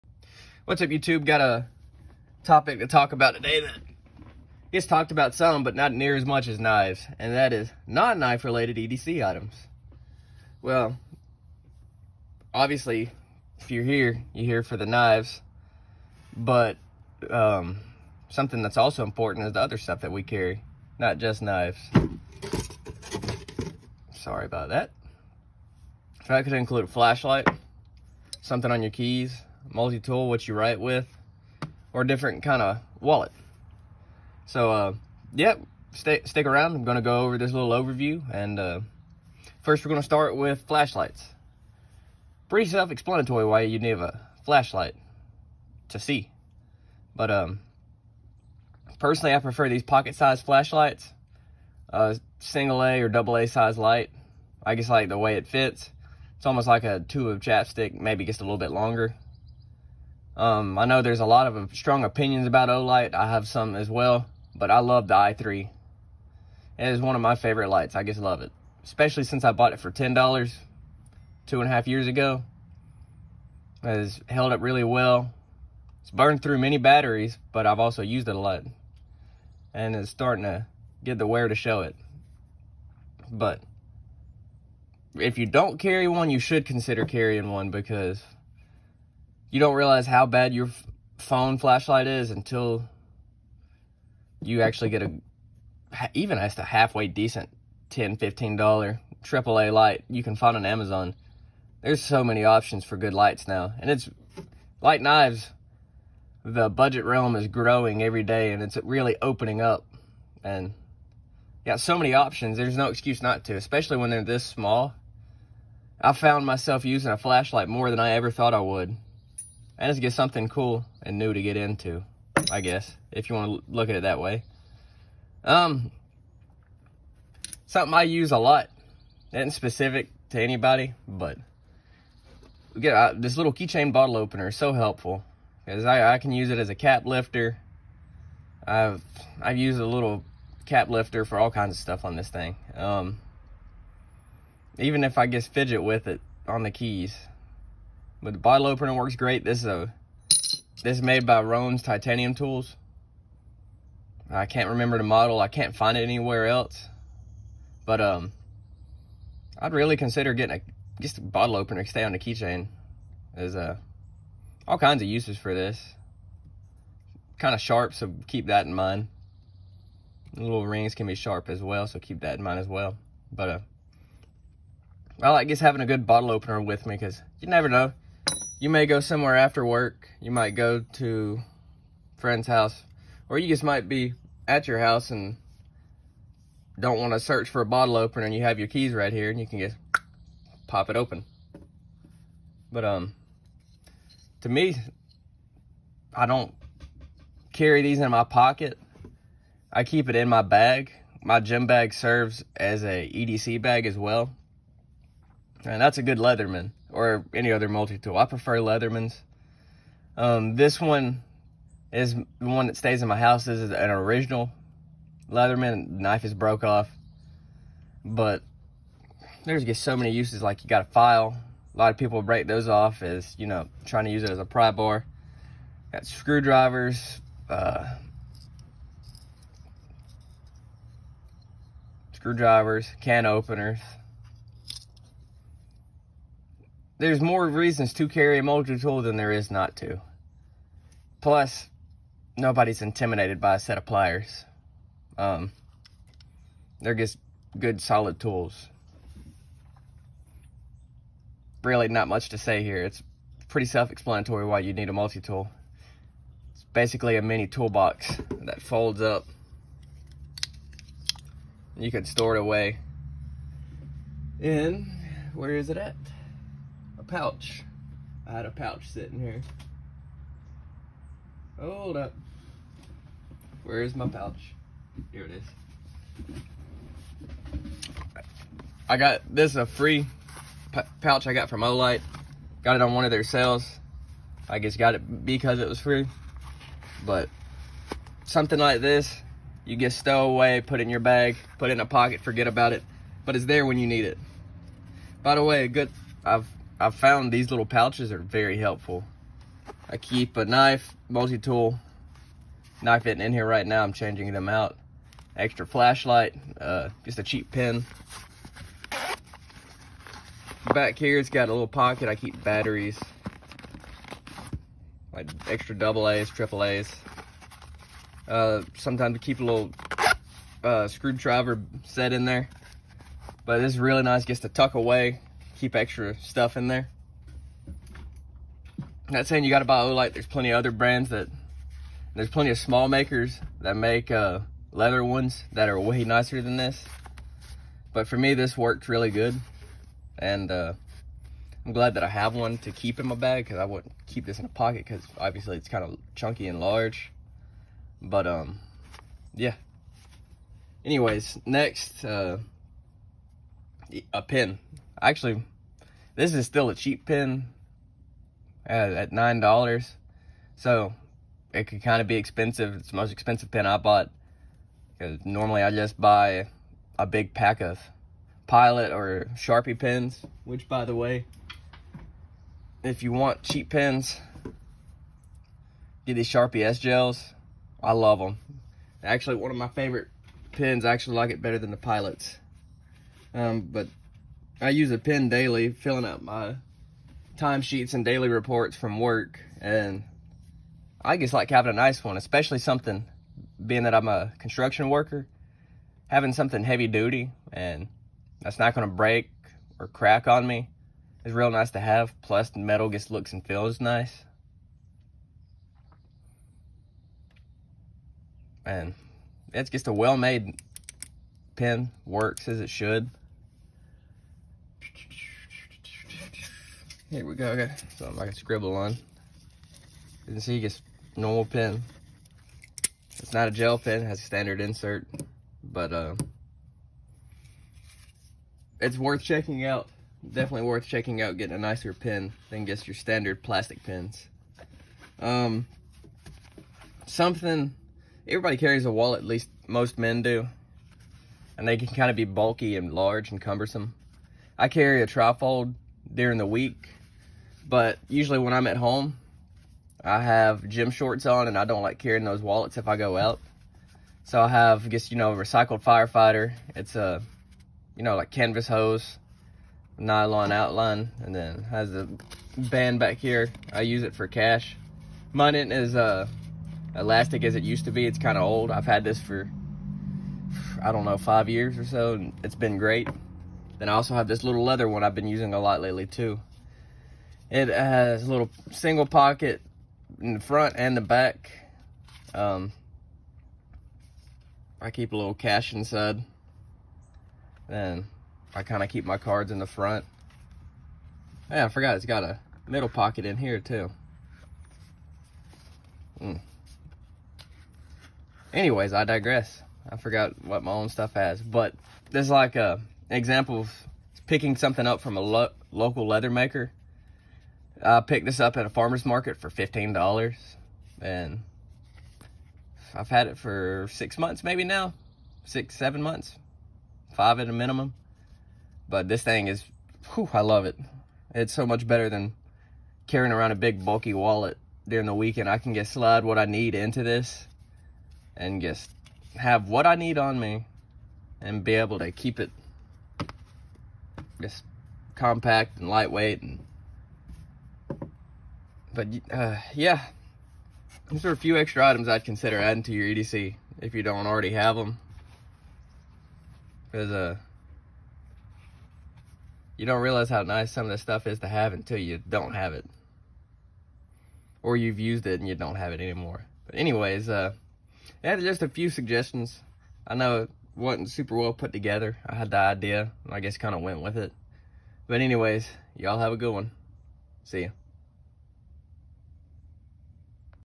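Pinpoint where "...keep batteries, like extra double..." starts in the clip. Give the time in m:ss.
5:12.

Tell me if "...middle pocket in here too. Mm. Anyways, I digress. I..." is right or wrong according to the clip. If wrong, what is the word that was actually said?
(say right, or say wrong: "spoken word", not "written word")
right.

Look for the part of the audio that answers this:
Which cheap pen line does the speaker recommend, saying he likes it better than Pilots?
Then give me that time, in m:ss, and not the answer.
6:16.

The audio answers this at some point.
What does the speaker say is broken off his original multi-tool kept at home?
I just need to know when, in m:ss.
3:35.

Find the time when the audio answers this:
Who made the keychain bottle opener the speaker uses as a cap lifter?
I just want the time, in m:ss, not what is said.
2:31.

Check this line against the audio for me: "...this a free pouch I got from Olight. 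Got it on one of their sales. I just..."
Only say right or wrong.
right.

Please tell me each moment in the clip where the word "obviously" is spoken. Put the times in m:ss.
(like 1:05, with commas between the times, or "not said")
0:12, 5:45.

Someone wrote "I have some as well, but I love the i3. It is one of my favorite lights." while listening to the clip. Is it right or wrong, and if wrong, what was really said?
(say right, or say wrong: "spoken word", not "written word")
right.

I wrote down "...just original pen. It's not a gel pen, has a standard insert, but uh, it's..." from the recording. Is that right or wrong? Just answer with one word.
wrong.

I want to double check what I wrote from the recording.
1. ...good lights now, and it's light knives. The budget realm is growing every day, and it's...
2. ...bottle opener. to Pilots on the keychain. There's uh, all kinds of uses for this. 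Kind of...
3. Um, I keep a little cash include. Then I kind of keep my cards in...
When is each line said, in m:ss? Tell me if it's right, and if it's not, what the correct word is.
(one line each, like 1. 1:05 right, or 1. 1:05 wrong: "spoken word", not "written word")
1. 1:42 right
2. 2:41 wrong: "Stay", not "Pilots"
3. 8:02 wrong: "inside", not "include".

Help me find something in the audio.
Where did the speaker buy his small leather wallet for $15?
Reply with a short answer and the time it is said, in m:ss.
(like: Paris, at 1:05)
A farmer's market, at 8:28.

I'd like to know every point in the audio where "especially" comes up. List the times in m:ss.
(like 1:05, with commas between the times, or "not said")
1:08, 1:53, 6:32.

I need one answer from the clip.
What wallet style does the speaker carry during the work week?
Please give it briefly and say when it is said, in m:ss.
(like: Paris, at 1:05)
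Trifold, at 7:25.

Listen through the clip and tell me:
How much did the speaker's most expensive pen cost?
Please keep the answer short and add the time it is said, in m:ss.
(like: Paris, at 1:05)
$9, at 5:59.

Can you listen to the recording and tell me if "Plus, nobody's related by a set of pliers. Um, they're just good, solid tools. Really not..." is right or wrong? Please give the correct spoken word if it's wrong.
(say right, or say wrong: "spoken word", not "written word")
wrong: "intimidated", not "related".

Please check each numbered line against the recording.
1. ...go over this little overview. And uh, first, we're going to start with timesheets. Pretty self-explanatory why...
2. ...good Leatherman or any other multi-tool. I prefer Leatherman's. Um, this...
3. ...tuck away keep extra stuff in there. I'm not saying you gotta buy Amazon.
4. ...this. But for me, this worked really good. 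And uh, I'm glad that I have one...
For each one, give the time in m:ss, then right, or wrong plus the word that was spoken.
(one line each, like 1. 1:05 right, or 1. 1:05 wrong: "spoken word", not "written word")
1. 0:37 wrong: "flashlights", not "timesheets"
2. 3:26 right
3. 5:24 wrong: "Olight", not "Amazon"
4. 5:36 right.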